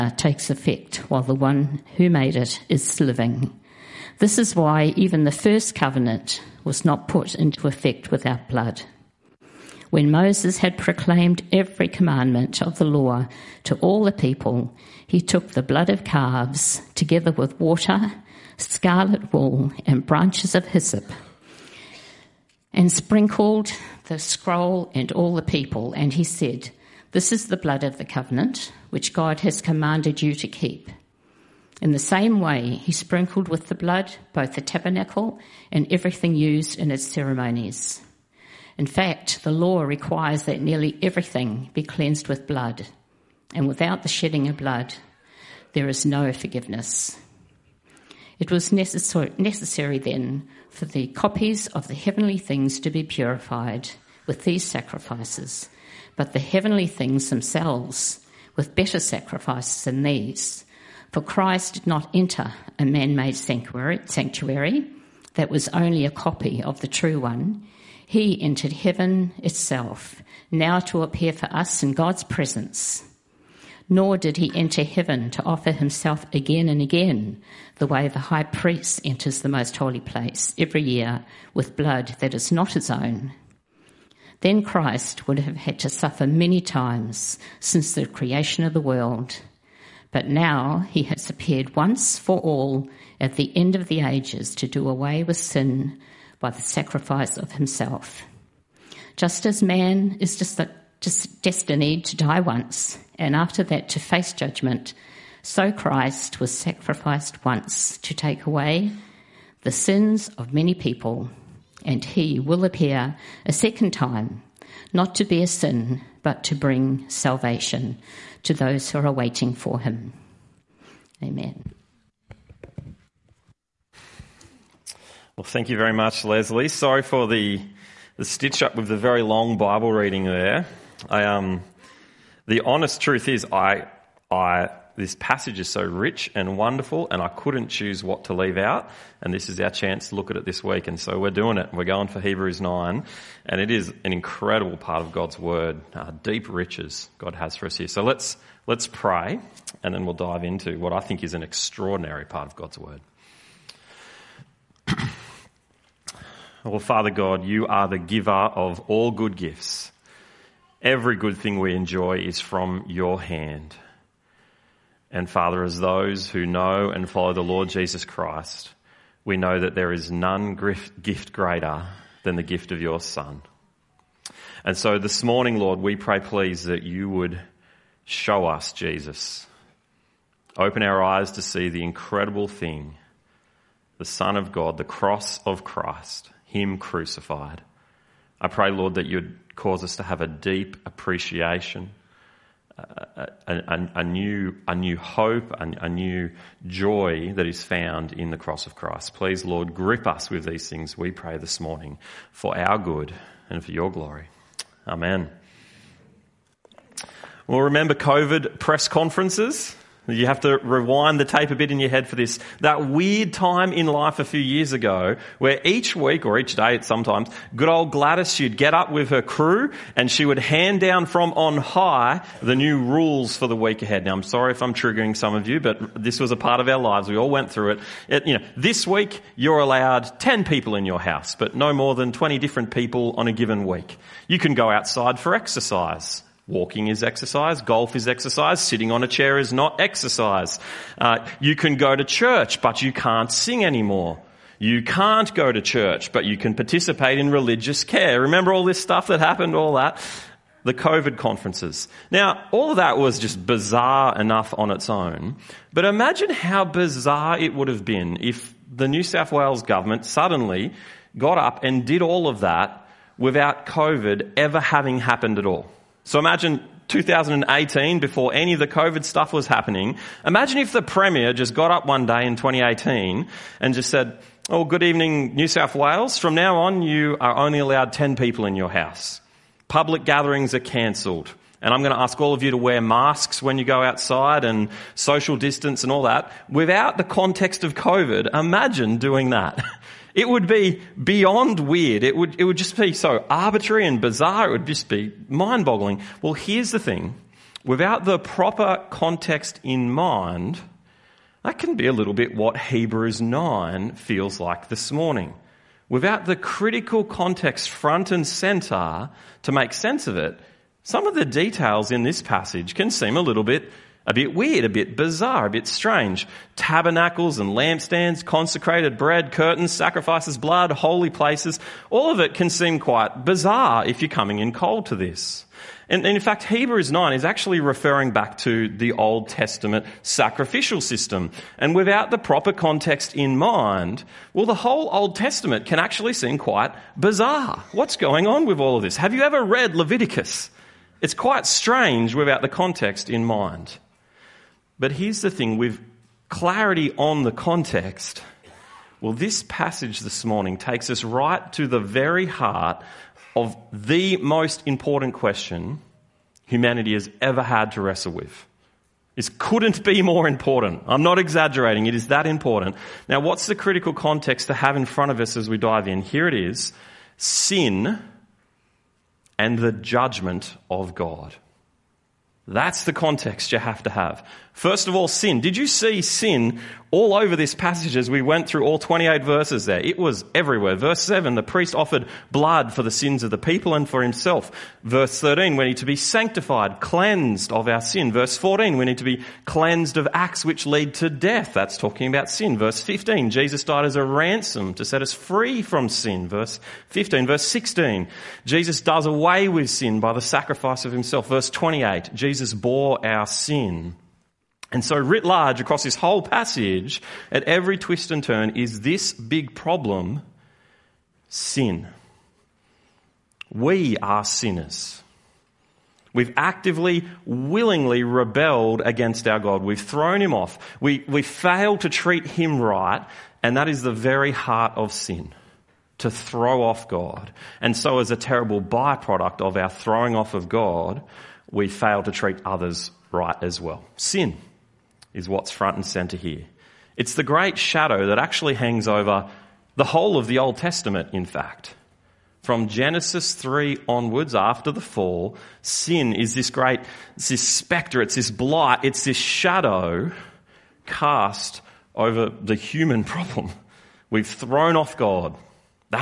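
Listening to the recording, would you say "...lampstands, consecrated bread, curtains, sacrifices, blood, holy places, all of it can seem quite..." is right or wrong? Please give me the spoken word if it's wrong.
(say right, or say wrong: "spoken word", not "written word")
right.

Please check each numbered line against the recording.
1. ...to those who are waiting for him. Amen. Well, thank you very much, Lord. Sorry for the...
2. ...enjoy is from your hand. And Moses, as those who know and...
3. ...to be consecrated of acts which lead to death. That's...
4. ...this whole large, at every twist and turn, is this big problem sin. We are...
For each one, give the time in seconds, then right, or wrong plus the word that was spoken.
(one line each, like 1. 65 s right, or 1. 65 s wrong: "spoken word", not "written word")
1. 118 s wrong: "Leslie", not "Lord"
2. 161 s wrong: "Father", not "Moses"
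3. 388 s wrong: "cleansed", not "consecrated"
4. 405 s wrong: "passage", not "large".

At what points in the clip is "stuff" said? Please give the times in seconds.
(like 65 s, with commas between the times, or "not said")
248 s, 269 s.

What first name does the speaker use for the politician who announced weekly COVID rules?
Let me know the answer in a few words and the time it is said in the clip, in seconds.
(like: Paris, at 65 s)
Gladys, at 217 s.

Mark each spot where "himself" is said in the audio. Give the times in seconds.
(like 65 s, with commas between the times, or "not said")
75 s, 97 s, 384 s, 400 s.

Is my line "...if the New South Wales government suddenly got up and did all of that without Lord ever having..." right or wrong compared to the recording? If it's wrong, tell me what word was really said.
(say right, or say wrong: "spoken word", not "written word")
wrong: "COVID", not "Lord".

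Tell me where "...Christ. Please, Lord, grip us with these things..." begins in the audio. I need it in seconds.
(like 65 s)
198 s.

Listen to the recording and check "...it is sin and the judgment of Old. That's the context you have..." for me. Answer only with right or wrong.
wrong.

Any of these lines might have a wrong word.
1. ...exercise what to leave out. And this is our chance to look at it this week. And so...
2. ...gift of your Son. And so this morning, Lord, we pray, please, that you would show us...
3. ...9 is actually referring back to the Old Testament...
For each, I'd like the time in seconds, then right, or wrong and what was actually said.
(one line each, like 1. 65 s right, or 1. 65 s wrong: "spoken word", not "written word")
1. 137 s wrong: "choose", not "exercise"
2. 172 s right
3. 326 s right.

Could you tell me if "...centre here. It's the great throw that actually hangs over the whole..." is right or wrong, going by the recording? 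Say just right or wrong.
wrong.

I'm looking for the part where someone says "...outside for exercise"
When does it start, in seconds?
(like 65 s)
234 s.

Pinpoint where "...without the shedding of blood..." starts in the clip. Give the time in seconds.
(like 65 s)
43 s.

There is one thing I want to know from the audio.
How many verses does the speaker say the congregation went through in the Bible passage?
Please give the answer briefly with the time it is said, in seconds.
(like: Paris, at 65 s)
28, at 378 s.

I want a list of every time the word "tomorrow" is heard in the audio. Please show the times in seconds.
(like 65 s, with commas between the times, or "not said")
not said.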